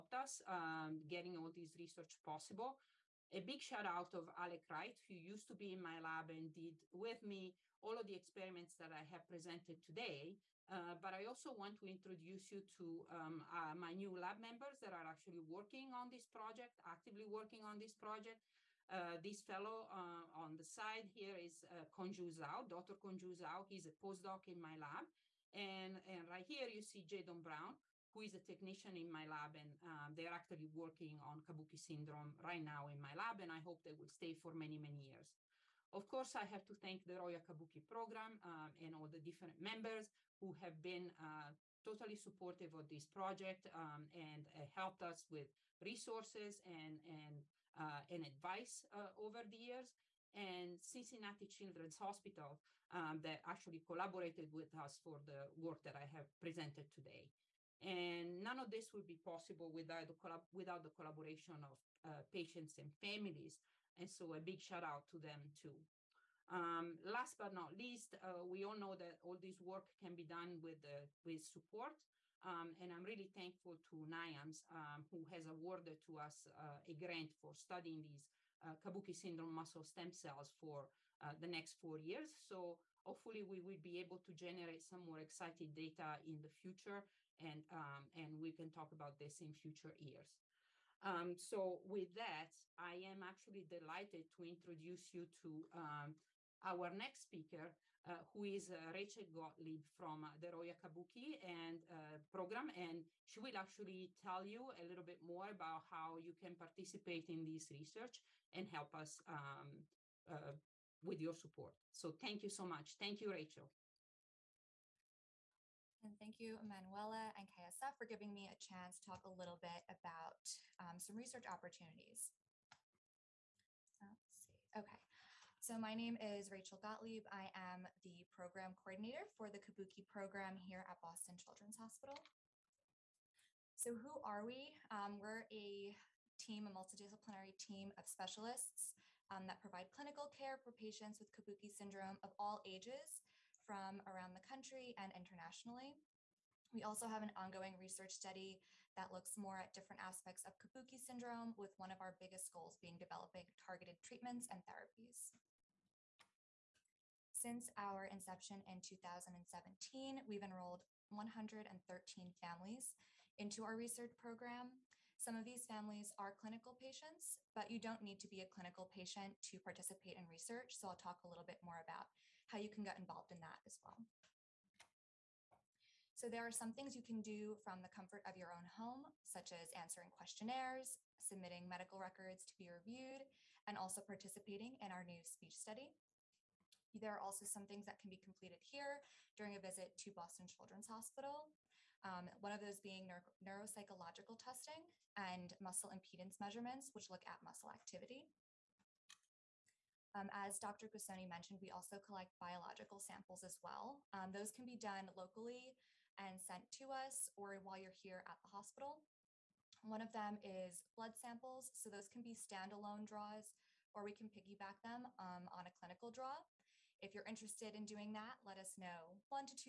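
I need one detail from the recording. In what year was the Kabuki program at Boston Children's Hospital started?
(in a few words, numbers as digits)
2017.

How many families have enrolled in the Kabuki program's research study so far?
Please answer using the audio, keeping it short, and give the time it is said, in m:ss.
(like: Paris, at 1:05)
113, at 2:41.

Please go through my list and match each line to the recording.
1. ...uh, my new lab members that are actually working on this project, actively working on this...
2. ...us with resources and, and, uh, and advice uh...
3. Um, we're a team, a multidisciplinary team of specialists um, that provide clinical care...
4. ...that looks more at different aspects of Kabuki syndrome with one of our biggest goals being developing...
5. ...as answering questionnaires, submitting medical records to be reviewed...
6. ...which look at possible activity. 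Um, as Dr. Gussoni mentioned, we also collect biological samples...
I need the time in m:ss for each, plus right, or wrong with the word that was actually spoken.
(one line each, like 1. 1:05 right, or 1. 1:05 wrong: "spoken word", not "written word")
1. 0:13 right
2. 0:45 right
3. 2:14 right
4. 2:28 right
5. 2:59 right
6. 3:16 wrong: "muscle", not "possible".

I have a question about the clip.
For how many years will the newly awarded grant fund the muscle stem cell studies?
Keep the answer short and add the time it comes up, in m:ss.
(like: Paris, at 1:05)
4, at 1:21.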